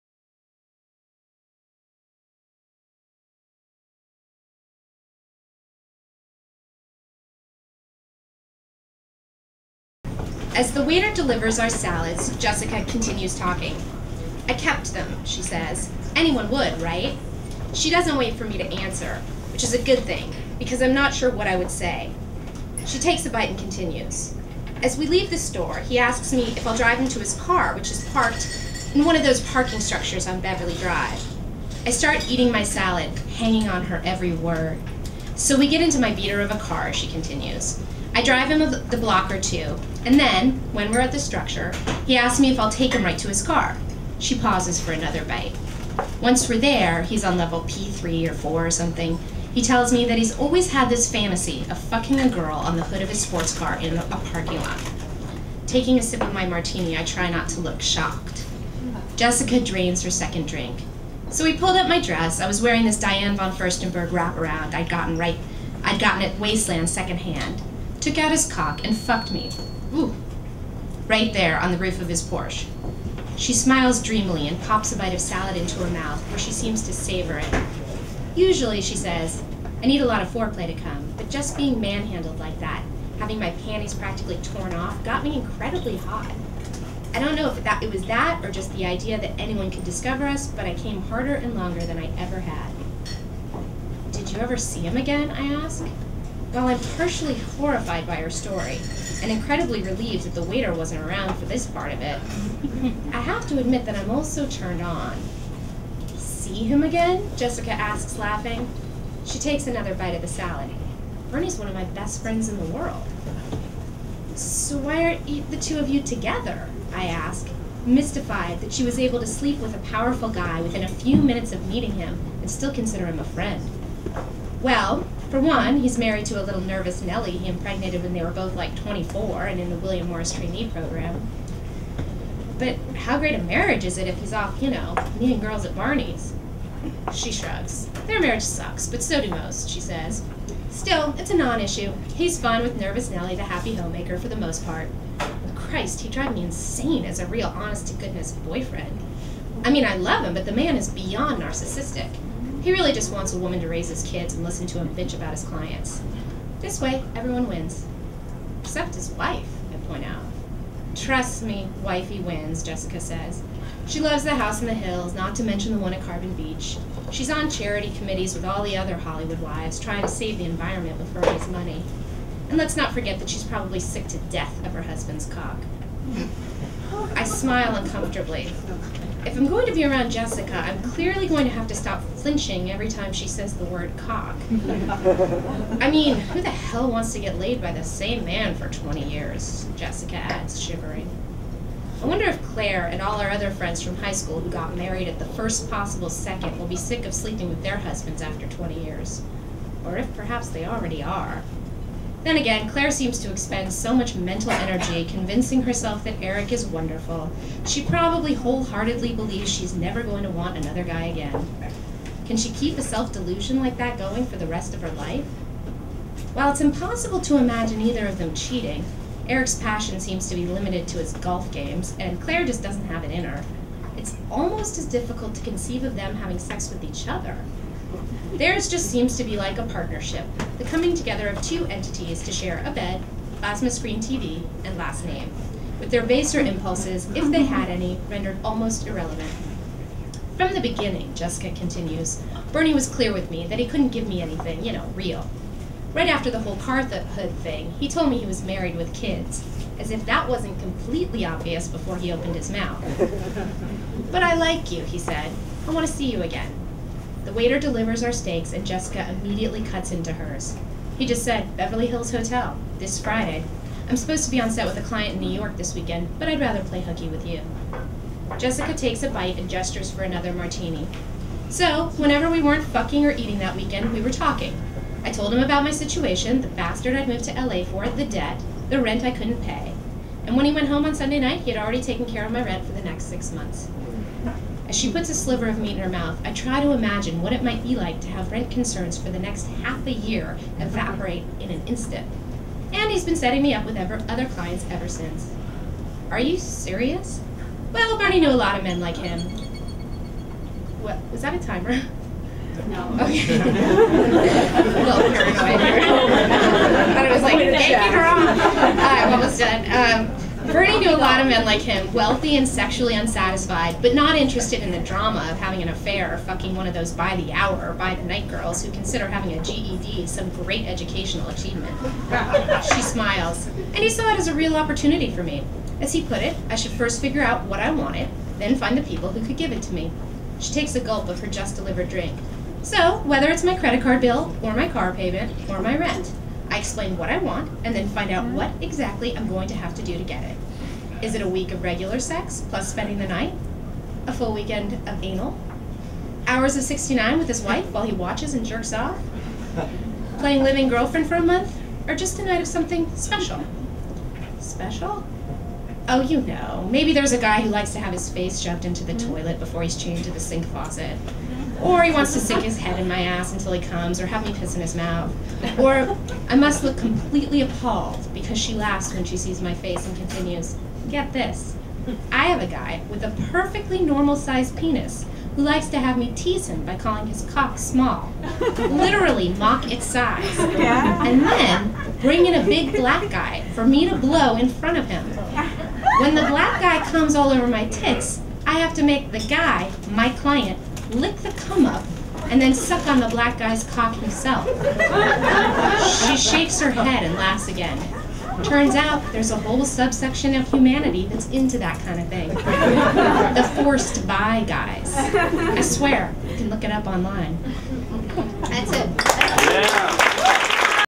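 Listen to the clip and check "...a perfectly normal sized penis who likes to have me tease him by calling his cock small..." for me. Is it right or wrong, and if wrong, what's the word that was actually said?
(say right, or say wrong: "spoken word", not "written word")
right.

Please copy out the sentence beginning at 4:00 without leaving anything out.
From the beginning, Jessica continues, Bernie was clear with me that he couldn't give me anything, you know, real.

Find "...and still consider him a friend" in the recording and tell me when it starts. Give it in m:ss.
2:02.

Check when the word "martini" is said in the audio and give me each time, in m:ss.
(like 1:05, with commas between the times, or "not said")
0:56, 4:30.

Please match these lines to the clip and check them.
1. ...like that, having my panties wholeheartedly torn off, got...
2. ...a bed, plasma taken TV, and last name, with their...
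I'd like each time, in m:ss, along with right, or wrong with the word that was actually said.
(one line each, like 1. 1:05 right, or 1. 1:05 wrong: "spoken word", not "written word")
1. 1:22 wrong: "practically", not "wholeheartedly"
2. 3:52 wrong: "screen", not "taken".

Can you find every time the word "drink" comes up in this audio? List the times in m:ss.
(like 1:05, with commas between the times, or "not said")
1:00, 5:31.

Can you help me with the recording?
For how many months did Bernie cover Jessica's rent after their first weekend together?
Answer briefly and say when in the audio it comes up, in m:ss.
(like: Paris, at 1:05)
6, at 4:43.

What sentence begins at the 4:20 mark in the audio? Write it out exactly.
He just said, Beverly Hills Hotel, this Friday.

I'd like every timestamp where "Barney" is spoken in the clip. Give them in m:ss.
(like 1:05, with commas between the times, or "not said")
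2:15, 4:57.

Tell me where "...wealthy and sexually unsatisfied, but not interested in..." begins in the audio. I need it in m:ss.
5:11.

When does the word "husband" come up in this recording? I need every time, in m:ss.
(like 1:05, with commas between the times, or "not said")
2:54, 3:17.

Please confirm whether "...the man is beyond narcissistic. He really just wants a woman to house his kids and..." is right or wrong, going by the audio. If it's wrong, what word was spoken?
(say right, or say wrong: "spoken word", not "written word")
wrong: "raise", not "house".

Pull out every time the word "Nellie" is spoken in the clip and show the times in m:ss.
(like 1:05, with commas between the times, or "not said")
2:07, 2:23.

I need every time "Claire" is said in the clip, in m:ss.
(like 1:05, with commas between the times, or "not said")
3:12, 3:22, 3:42.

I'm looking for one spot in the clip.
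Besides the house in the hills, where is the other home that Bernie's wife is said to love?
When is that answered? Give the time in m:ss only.
2:46.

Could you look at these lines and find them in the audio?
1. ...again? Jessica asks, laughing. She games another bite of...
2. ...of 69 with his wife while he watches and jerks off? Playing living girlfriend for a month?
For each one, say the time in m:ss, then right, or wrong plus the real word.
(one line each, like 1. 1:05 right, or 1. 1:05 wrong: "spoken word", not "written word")
1. 1:46 wrong: "takes", not "games"
2. 5:46 right.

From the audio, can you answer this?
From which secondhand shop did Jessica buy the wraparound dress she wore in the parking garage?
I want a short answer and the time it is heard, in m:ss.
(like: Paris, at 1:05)
Wasteland, at 1:06.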